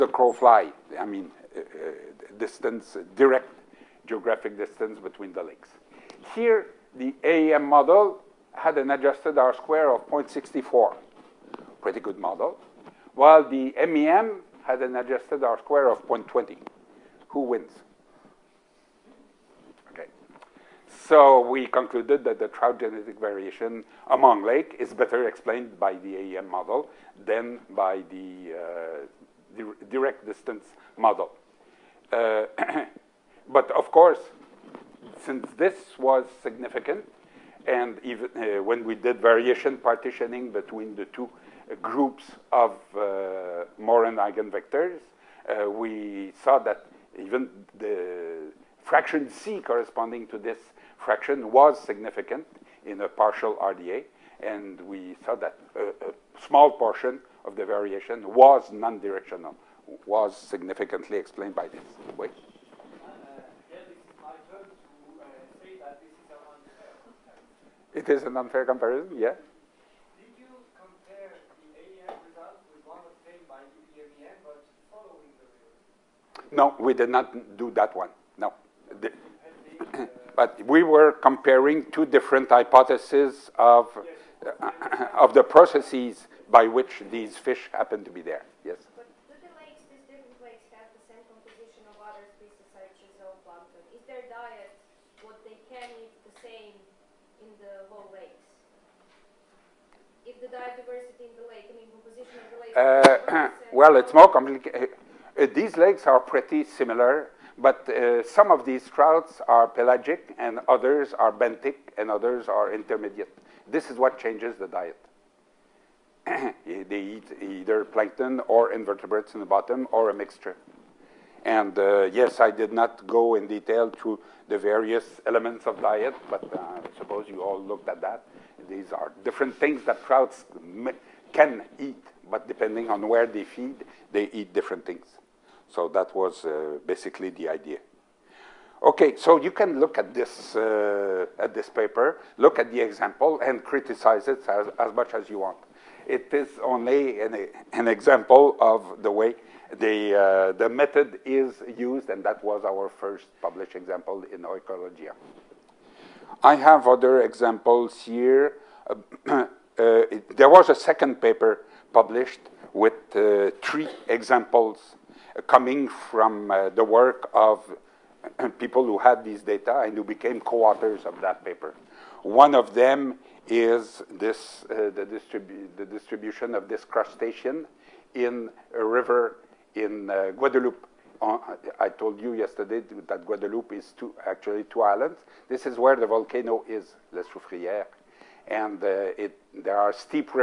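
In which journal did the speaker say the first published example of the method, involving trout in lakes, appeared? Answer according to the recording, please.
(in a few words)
Oikologia.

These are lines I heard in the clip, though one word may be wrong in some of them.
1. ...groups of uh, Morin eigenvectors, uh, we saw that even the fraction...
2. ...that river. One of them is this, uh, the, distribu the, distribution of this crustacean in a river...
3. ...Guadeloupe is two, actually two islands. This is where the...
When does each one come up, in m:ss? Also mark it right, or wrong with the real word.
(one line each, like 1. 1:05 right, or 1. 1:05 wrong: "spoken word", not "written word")
1. 0:41 right
2. 2:51 wrong: "paper", not "river"
3. 3:03 right.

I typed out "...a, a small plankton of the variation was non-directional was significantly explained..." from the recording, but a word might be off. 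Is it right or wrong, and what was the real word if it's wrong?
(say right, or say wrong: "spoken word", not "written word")
wrong: "portion", not "plankton".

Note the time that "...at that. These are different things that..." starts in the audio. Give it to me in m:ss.
2:07.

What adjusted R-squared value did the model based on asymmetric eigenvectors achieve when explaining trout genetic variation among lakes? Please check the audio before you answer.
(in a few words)
0.64.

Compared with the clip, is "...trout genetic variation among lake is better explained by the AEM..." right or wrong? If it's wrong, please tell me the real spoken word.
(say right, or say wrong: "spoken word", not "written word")
right.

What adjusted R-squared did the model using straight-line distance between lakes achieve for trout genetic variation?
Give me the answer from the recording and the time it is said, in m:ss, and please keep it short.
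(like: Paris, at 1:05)
0.20, at 0:16.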